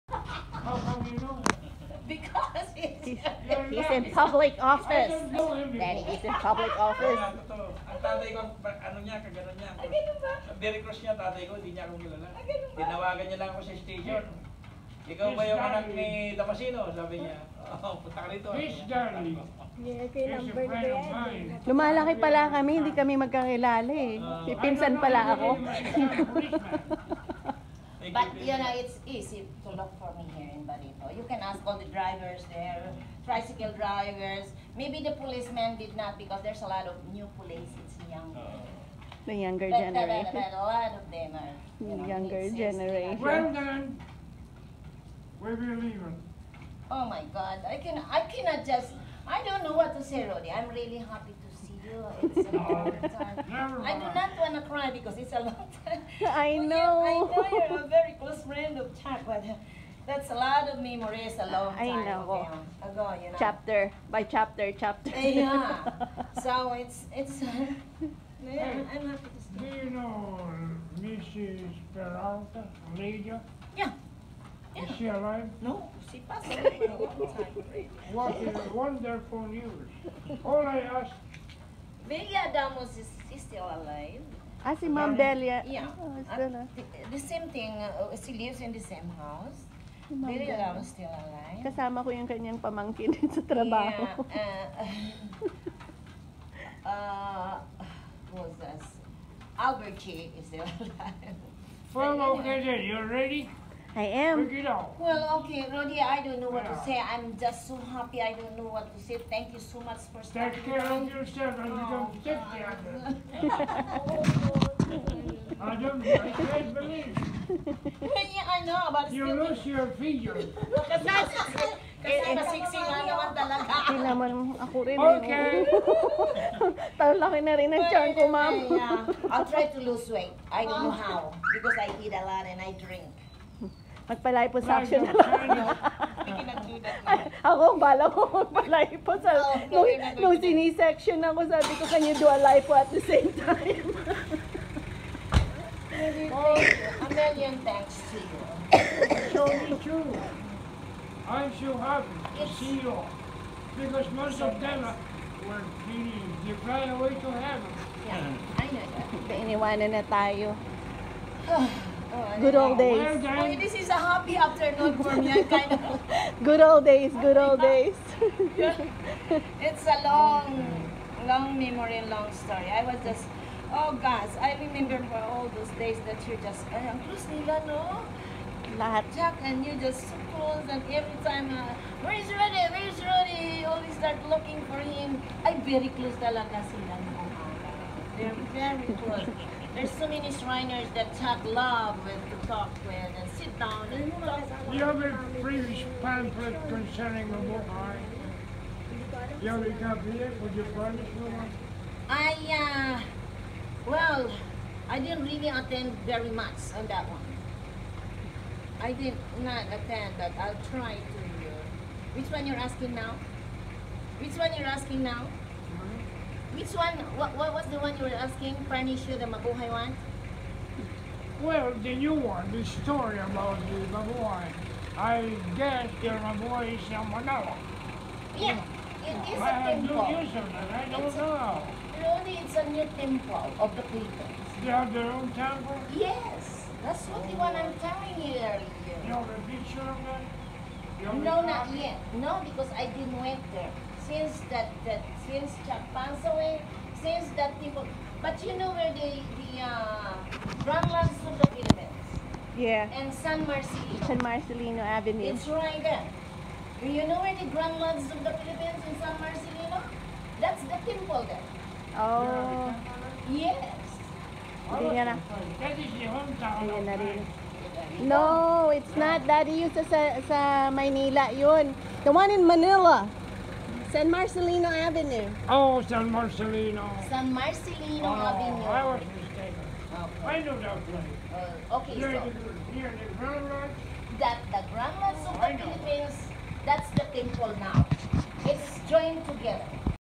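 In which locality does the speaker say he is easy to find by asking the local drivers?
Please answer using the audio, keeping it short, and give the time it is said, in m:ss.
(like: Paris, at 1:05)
Barito, at 0:30.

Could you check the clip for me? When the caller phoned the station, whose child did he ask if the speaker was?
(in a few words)
Damasino.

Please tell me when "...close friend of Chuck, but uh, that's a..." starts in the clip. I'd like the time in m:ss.
0:58.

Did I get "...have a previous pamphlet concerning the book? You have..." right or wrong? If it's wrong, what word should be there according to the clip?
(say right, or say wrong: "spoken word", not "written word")
right.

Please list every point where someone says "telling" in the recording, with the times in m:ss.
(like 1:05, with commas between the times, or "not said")
3:57.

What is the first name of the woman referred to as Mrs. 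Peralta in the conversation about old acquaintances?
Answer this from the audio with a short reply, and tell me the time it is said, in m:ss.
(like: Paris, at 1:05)
Lydia, at 1:12.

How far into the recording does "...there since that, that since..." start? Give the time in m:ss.
4:03.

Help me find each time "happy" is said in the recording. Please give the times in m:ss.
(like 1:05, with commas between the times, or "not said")
0:50, 1:08, 1:47, 2:31, 2:44.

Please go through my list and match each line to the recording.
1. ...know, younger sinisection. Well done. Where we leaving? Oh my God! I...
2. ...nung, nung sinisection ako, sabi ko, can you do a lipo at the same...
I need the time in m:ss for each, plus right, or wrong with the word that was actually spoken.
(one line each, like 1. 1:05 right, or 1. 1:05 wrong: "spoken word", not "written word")
1. 0:41 wrong: "generation", not "sinisection"
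2. 2:19 right.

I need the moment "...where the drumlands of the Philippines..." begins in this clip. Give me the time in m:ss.
4:17.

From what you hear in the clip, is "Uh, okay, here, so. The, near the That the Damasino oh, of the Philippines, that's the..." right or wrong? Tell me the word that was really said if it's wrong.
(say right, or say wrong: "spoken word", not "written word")
wrong: "Grand", not "Damasino".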